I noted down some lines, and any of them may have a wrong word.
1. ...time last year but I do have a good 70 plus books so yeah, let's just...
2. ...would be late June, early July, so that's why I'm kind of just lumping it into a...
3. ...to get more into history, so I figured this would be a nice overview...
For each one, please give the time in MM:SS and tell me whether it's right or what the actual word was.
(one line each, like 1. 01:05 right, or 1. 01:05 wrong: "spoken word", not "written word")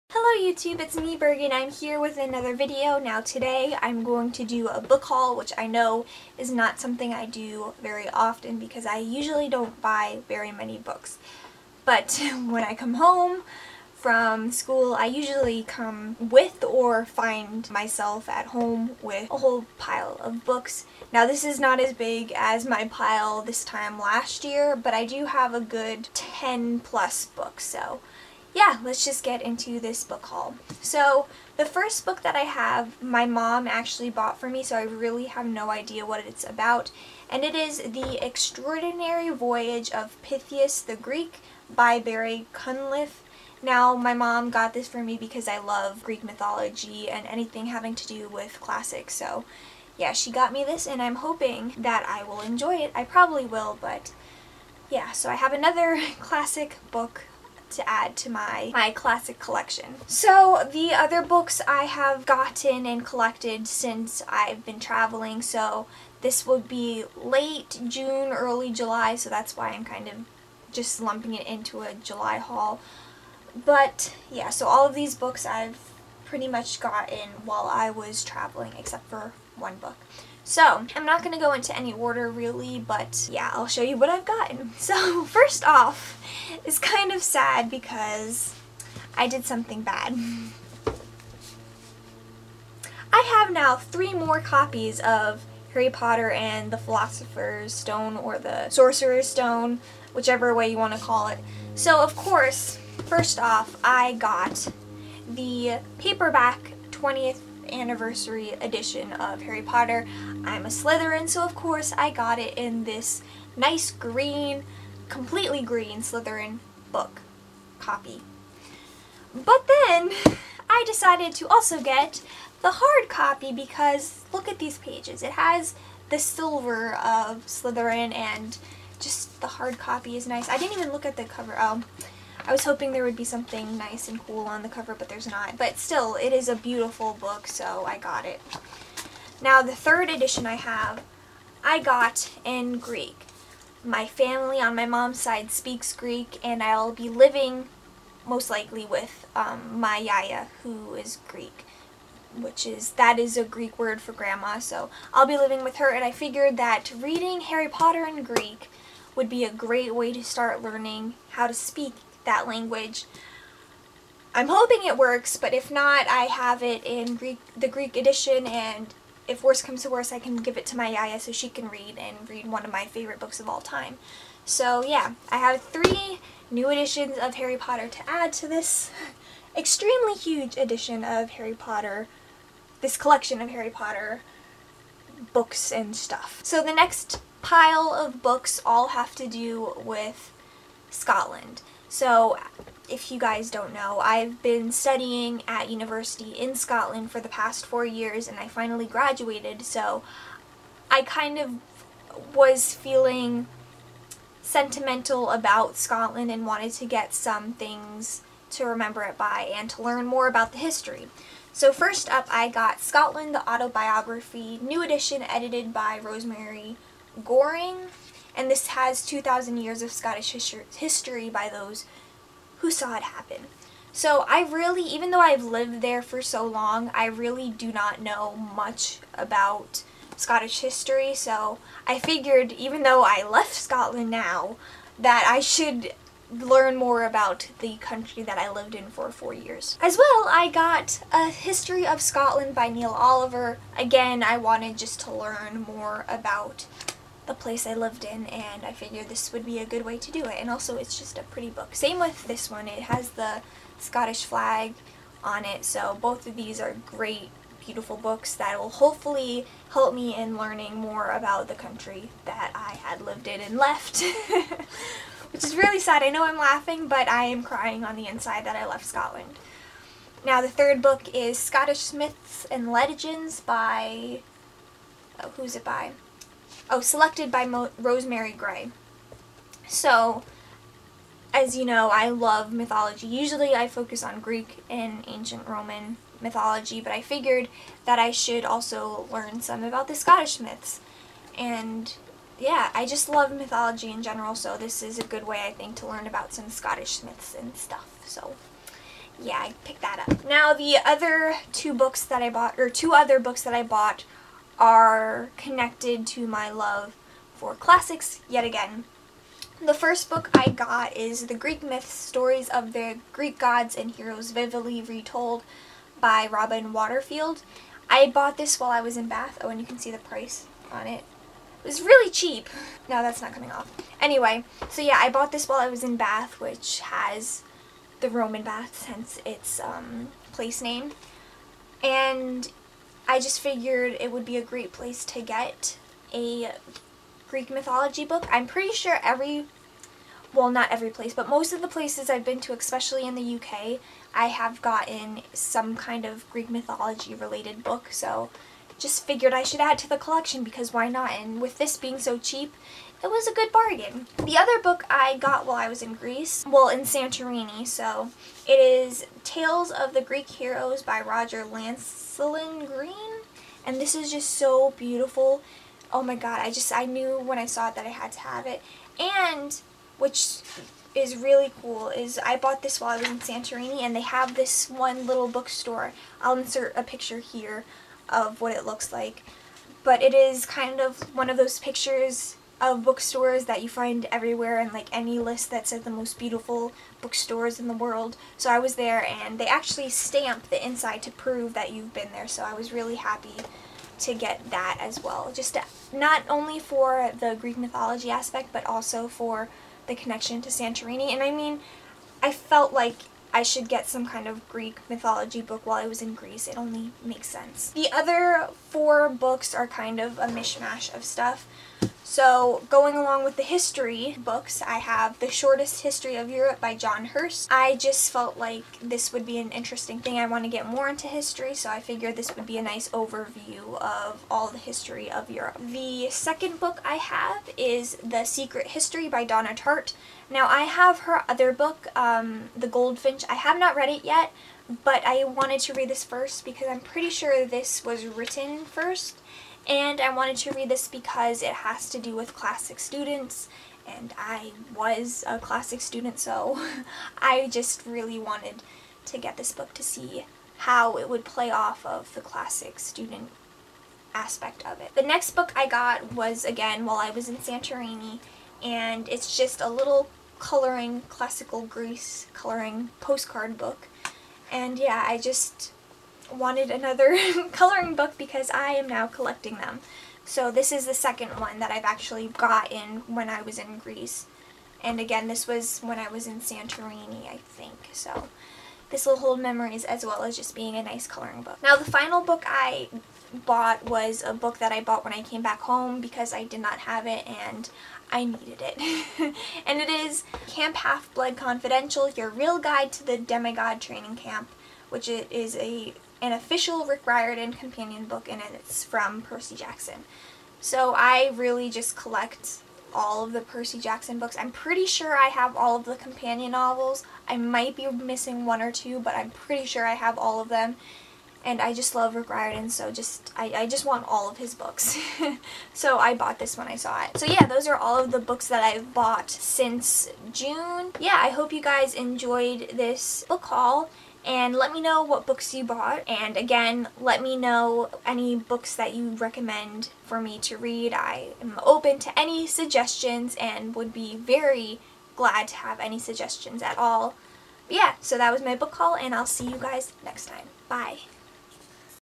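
1. 00:23 wrong: "10", not "70"
2. 01:06 right
3. 07:00 right.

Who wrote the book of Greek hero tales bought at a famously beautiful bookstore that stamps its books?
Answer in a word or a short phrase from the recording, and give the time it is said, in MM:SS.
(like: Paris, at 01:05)
Roger Lancelyn Green, at 06:01.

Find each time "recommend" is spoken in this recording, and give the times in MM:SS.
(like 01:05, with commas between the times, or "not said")
08:49.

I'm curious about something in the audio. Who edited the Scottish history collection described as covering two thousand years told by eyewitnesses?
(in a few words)
Rosemary Goring.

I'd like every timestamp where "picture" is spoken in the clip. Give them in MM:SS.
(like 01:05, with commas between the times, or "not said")
06:16, 06:21.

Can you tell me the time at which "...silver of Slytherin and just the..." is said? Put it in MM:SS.
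02:06.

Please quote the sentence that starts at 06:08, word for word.
And which is really cool is I bought this while I was in Santorini and they have this one little bookstore.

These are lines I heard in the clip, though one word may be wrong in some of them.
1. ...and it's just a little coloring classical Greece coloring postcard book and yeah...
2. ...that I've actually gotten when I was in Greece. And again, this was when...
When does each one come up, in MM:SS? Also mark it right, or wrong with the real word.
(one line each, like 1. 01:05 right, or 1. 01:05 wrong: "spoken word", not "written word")
1. 07:38 right
2. 07:51 right.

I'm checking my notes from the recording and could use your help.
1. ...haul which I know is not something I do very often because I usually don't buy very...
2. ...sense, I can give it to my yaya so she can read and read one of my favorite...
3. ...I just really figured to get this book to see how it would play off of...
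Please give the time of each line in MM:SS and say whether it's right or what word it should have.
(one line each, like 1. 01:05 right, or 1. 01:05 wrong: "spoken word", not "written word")
1. 00:05 right
2. 02:49 wrong: "worse", not "sense"
3. 07:27 wrong: "wanted", not "figured".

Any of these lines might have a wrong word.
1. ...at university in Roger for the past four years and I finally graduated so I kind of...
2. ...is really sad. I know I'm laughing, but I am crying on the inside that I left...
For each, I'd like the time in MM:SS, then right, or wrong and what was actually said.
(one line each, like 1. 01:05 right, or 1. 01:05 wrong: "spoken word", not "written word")
1. 03:15 wrong: "Scotland", not "Roger"
2. 04:25 right.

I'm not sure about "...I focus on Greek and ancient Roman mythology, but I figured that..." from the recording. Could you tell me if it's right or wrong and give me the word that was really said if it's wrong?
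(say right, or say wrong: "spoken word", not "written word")
right.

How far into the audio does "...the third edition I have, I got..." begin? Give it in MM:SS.
02:19.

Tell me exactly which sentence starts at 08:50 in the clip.
I am open to any suggestions and would be very glad to have any suggestions at all.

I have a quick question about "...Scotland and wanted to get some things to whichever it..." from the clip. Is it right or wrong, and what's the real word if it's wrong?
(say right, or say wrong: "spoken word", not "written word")
wrong: "remember", not "whichever".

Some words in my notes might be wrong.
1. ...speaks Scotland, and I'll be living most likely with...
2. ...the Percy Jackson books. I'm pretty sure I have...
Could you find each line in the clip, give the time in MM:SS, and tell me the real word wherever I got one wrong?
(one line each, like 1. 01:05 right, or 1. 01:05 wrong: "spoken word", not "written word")
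1. 02:25 wrong: "Greek", not "Scotland"
2. 08:23 right.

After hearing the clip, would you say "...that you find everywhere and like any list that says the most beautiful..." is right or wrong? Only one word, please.
right.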